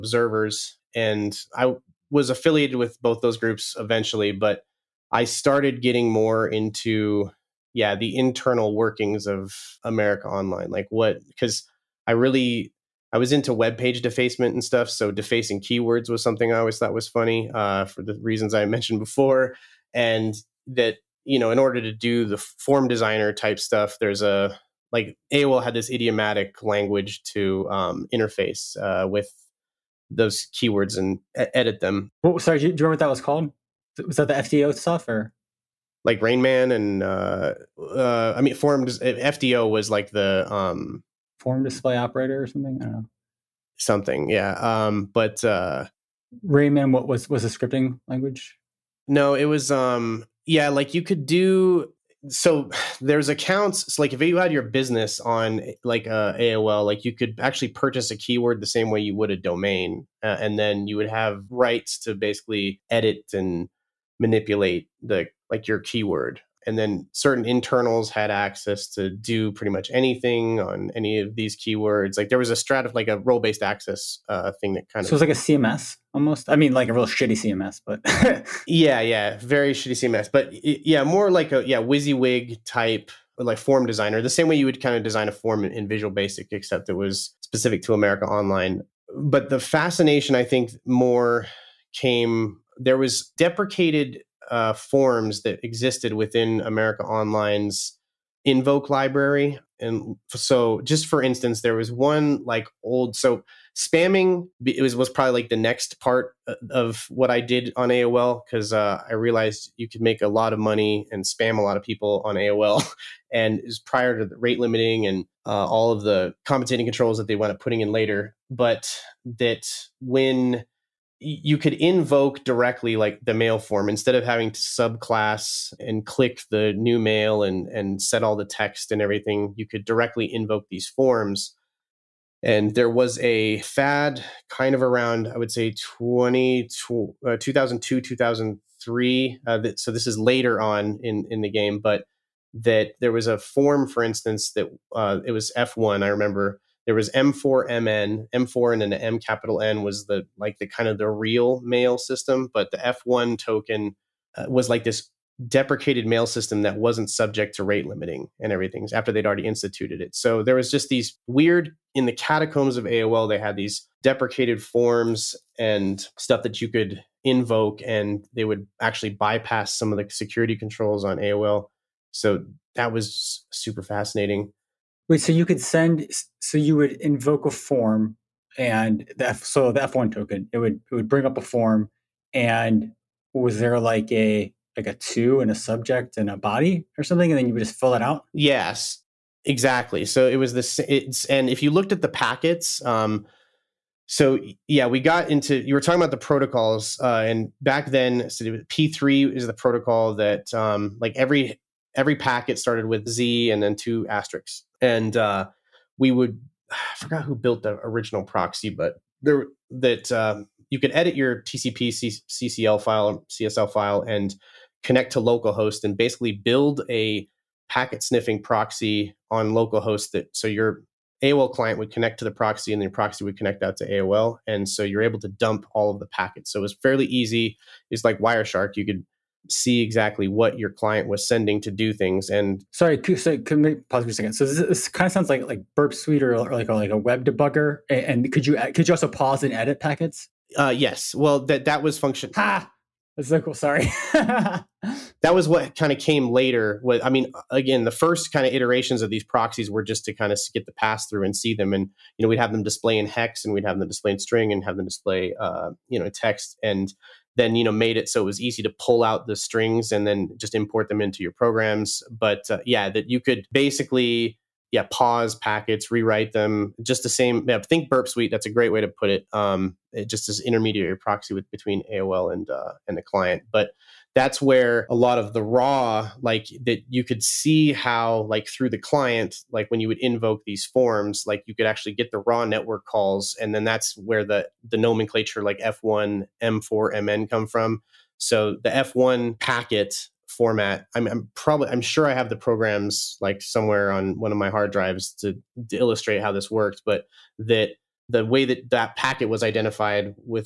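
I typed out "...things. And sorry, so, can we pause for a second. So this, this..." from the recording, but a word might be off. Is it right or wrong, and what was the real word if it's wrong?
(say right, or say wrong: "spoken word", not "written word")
right.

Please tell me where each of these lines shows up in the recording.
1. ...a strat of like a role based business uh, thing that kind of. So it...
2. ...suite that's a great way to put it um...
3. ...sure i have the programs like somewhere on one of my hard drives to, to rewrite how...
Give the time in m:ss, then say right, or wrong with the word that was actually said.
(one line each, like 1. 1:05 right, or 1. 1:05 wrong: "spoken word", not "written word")
1. 1:12 wrong: "access", not "business"
2. 4:28 right
3. 4:51 wrong: "illustrate", not "rewrite".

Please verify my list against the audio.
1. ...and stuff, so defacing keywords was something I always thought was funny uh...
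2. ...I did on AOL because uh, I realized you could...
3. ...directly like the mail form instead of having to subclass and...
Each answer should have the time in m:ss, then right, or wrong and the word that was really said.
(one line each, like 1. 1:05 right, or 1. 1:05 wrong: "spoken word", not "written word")
1. 0:14 right
2. 1:47 right
3. 2:02 right.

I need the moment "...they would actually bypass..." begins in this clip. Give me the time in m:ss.
2:48.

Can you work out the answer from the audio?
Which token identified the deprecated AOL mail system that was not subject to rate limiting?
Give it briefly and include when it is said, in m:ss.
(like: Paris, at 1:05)
F1, at 2:32.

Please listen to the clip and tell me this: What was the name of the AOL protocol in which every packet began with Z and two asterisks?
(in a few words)
P3.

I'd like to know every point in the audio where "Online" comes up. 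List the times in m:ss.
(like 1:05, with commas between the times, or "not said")
0:10, 1:28, 1:37.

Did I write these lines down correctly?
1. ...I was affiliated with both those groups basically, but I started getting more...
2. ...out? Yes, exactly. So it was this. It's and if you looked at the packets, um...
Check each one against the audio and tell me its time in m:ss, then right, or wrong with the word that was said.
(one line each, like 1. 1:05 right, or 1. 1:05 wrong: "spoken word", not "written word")
1. 0:01 wrong: "eventually", not "basically"
2. 3:08 right.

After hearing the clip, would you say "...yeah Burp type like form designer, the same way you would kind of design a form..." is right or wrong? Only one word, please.
wrong.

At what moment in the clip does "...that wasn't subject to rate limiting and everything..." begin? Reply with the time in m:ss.
2:36.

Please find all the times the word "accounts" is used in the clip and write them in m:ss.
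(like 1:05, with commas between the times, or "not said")
0:53.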